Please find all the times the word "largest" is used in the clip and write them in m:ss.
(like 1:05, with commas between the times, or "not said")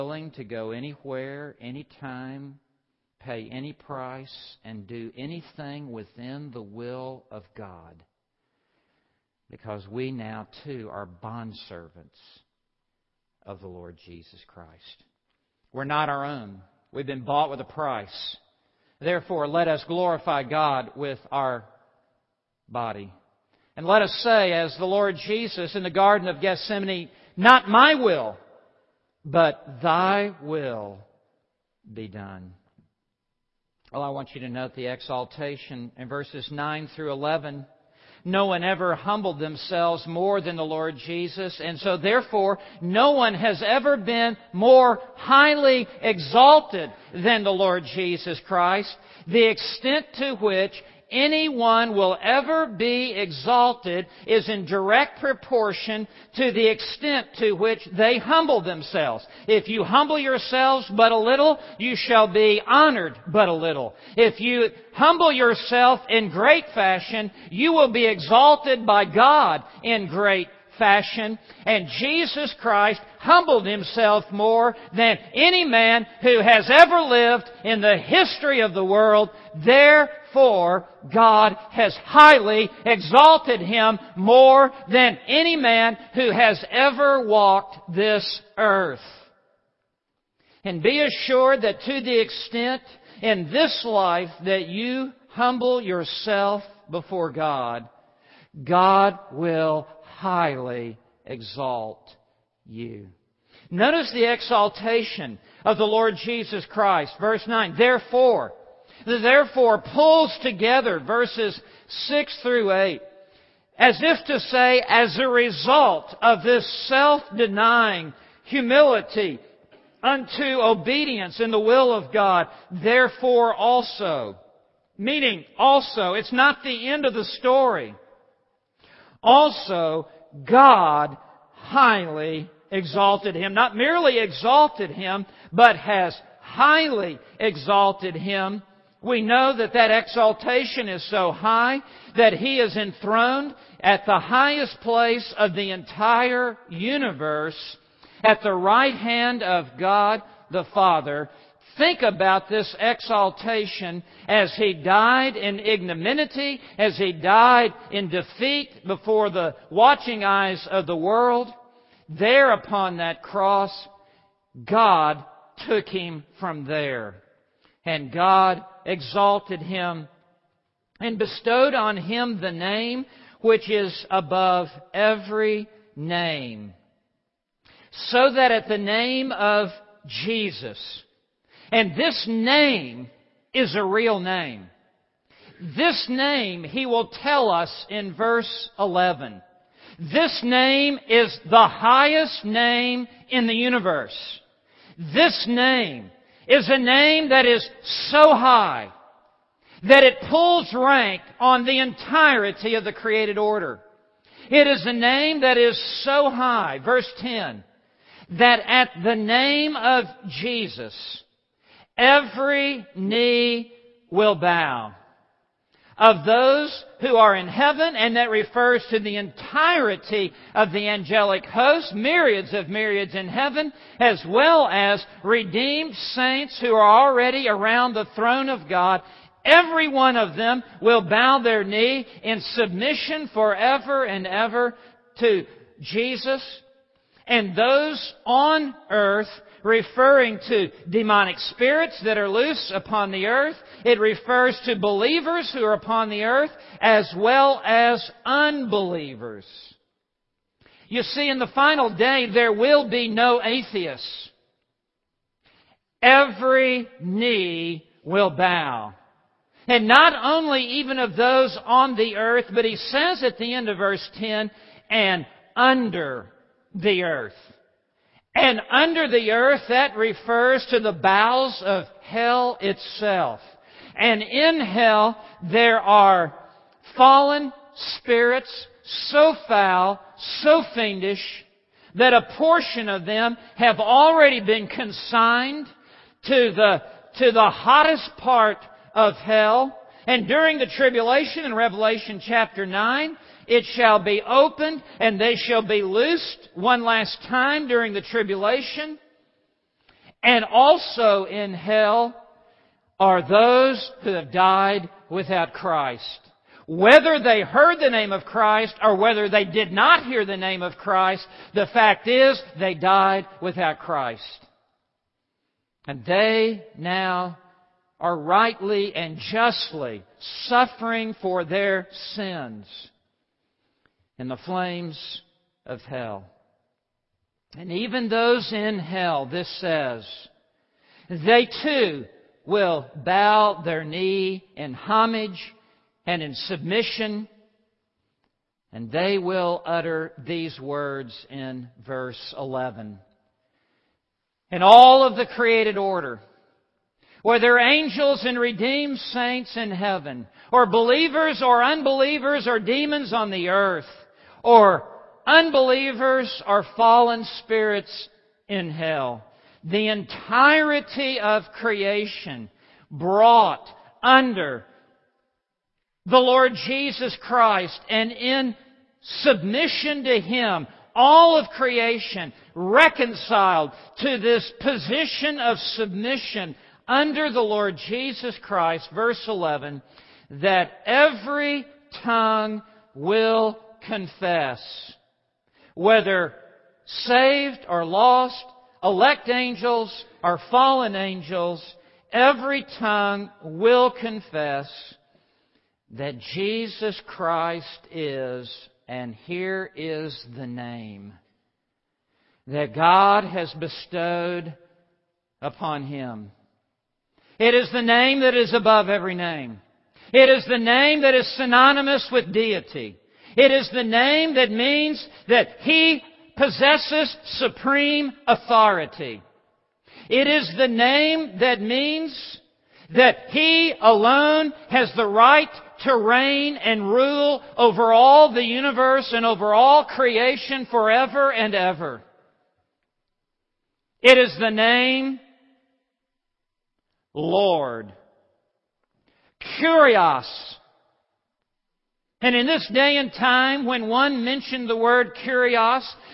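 not said.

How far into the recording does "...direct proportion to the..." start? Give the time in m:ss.
0:54.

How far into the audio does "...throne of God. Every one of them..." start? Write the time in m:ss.
3:48.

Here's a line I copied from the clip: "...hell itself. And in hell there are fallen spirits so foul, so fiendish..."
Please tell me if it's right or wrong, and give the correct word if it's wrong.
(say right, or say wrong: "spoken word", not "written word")
right.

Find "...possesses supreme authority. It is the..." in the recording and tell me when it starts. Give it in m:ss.
6:56.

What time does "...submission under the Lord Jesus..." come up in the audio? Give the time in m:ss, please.
6:15.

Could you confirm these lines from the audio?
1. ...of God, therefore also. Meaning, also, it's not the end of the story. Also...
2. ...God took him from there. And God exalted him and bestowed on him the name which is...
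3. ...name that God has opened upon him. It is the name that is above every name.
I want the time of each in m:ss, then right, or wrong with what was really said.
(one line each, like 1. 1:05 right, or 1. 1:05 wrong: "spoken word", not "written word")
1. 2:01 right
2. 2:44 right
3. 6:40 wrong: "bestowed", not "opened".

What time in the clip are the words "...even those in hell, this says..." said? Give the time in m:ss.
5:27.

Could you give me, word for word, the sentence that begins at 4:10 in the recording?
You see, in the final day, there will be no atheists.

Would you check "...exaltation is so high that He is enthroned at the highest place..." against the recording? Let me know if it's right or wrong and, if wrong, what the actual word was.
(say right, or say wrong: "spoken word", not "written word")
right.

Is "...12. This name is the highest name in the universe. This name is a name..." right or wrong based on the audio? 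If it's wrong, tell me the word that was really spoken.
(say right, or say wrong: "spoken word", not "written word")
wrong: "11", not "12".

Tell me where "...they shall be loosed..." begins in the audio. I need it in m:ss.
4:55.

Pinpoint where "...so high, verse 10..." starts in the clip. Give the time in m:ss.
3:26.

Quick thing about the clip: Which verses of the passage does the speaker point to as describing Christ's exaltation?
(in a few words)
9 through 11.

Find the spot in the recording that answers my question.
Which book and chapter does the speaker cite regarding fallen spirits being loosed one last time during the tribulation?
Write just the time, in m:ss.
4:51.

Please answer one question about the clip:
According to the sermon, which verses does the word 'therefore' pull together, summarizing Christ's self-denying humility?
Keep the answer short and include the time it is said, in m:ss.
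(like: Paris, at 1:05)
6 through 8, at 1:50.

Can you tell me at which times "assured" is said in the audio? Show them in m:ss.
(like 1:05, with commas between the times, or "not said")
1:31.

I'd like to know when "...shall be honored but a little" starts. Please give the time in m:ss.
1:01.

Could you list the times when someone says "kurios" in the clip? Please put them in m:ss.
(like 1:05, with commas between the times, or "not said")
7:19, 7:25.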